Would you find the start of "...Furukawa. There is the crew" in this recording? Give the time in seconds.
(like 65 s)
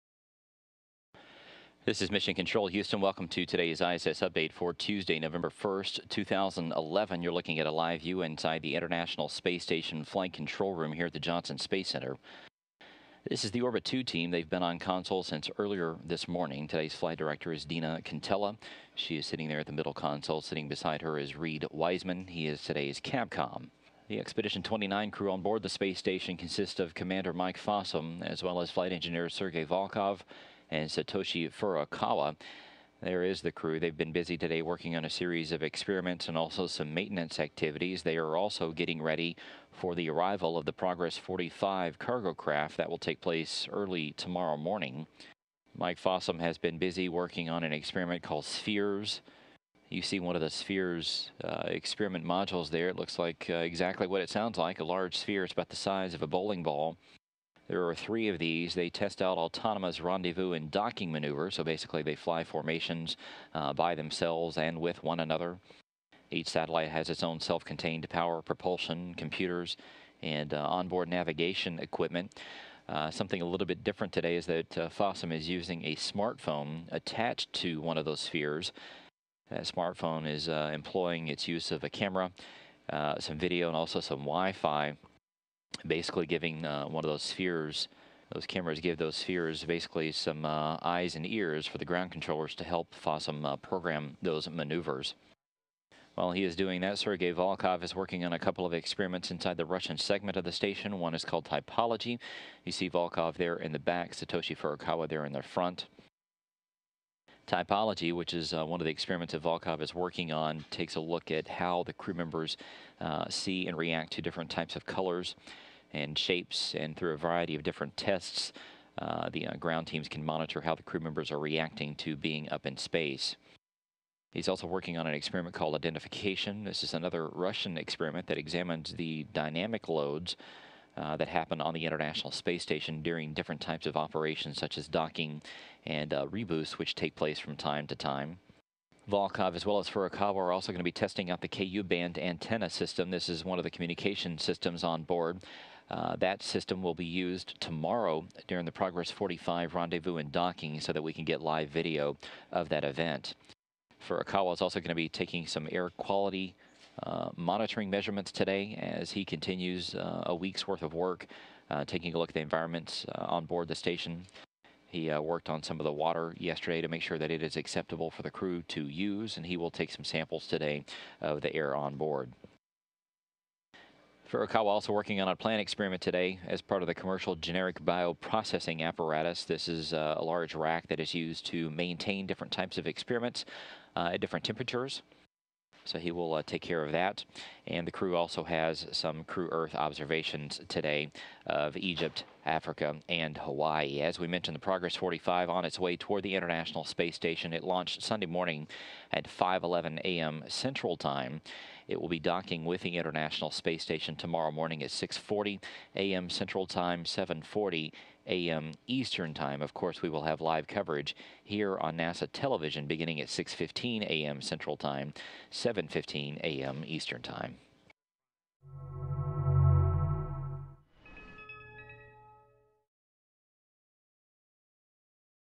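31 s.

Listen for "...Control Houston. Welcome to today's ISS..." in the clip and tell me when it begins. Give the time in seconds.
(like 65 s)
2 s.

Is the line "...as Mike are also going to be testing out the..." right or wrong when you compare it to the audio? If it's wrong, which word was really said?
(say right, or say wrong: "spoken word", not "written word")
wrong: "Furukawa", not "Mike".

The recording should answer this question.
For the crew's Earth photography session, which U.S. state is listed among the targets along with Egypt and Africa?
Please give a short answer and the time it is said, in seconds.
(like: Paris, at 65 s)
Hawaii, at 193 s.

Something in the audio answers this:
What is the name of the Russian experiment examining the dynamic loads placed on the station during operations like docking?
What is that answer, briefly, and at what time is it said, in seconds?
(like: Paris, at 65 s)
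Identification, at 125 s.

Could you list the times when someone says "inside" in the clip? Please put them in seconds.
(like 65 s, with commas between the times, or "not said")
8 s, 99 s.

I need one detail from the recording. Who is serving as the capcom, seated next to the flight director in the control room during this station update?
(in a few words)
Reed Wiseman.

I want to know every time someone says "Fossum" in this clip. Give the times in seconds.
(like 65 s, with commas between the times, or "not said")
27 s, 45 s, 74 s, 92 s.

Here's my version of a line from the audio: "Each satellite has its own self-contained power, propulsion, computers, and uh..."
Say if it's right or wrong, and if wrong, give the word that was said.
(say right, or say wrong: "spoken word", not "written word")
right.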